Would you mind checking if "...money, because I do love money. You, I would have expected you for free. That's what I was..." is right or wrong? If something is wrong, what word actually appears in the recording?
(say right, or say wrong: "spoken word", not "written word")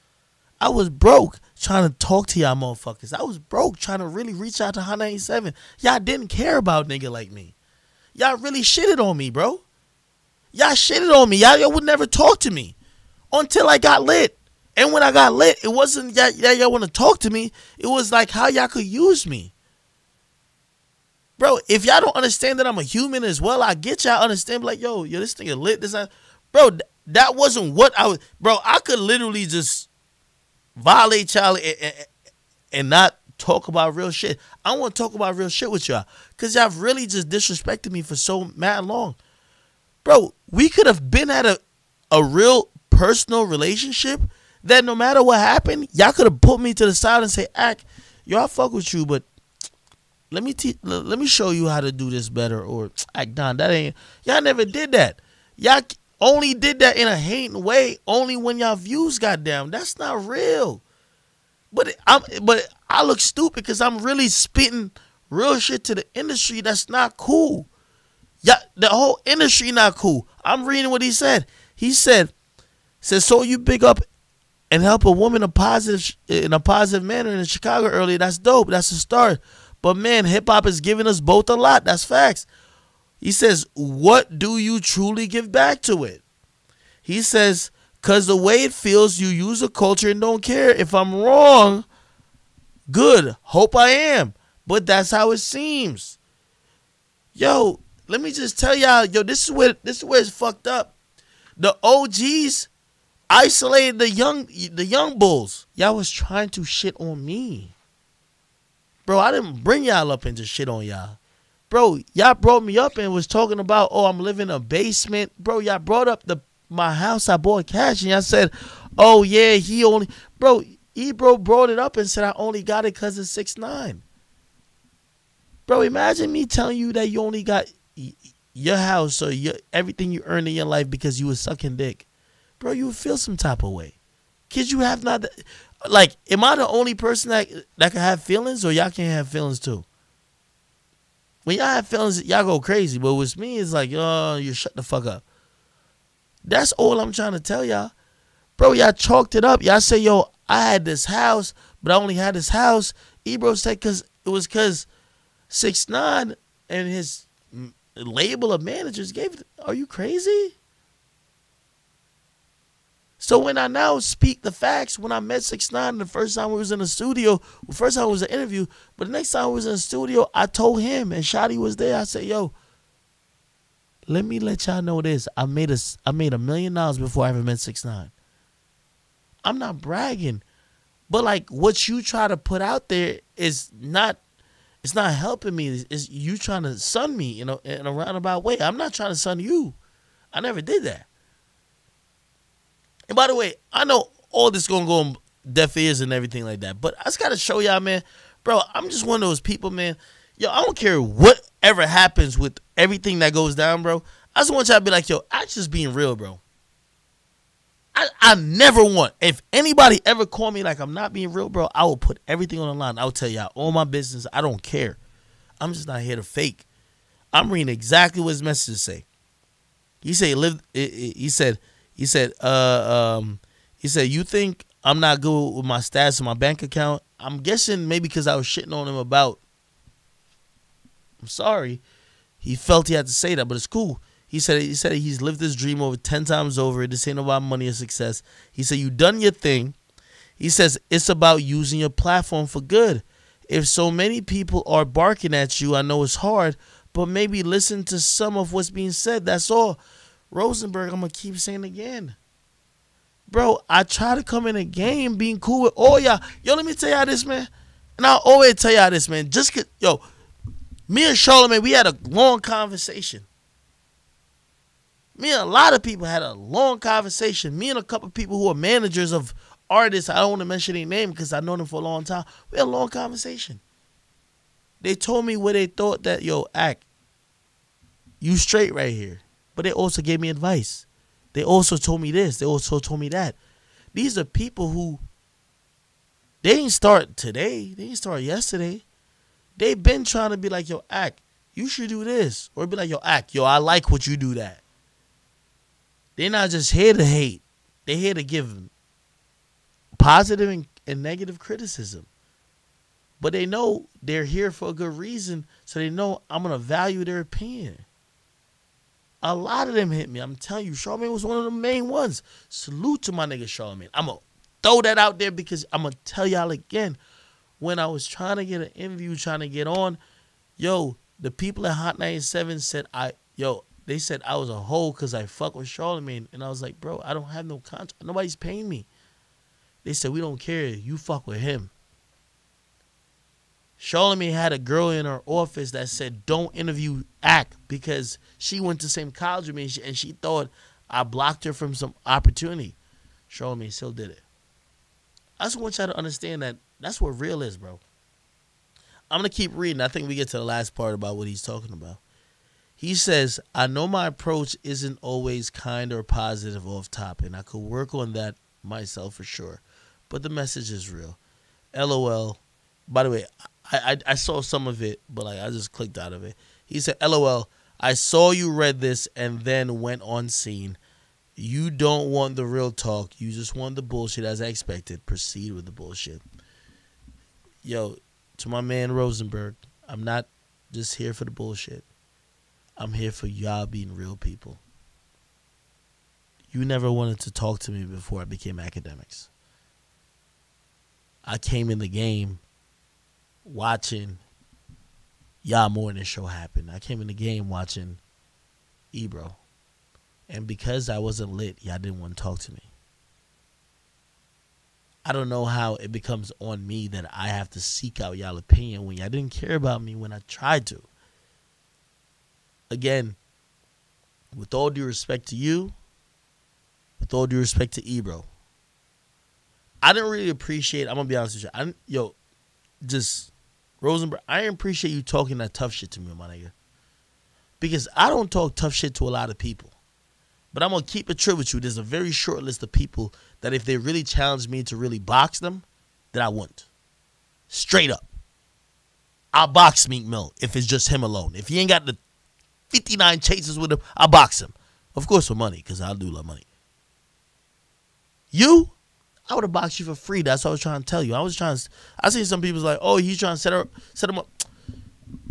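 wrong: "boxed", not "expected".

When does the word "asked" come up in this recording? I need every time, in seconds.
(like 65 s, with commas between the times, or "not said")
not said.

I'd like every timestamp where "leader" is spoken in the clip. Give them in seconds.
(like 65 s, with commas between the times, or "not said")
not said.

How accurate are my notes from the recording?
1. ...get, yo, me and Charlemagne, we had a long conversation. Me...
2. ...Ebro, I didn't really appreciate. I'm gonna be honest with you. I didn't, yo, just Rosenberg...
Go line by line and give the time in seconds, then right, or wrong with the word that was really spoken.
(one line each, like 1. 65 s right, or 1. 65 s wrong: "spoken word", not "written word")
1. 259 s right
2. 417 s right.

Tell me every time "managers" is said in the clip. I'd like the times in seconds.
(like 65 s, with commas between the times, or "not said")
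158 s, 268 s.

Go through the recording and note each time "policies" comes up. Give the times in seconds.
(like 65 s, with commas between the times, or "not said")
not said.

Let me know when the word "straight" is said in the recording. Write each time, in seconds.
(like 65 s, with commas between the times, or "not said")
278 s, 437 s.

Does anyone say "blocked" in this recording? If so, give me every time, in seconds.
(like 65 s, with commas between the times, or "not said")
341 s.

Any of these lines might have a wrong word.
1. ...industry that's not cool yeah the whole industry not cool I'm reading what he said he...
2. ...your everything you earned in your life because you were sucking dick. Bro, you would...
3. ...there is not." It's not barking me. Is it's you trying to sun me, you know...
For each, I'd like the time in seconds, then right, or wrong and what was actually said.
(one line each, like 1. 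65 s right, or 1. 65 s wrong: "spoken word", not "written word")
1. 66 s right
2. 129 s right
3. 182 s wrong: "helping", not "barking".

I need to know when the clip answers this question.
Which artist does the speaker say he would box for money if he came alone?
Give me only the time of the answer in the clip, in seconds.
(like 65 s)
439 s.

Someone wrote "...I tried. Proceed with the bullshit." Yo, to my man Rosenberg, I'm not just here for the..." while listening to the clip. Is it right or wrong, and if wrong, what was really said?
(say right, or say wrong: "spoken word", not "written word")
wrong: "expected", not "tried".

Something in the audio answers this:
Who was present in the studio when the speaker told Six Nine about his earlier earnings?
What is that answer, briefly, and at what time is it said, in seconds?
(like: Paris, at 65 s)
Shotti, at 171 s.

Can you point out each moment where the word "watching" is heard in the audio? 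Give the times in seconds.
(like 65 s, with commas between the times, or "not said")
393 s, 397 s.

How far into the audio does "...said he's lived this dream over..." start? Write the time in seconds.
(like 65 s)
234 s.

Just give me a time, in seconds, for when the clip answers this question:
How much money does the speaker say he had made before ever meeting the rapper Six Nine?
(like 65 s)
176 s.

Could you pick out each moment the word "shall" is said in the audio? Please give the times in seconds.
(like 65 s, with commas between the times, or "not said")
not said.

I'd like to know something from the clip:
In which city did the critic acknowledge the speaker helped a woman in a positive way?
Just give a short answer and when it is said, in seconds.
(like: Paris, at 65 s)
Chicago, at 77 s.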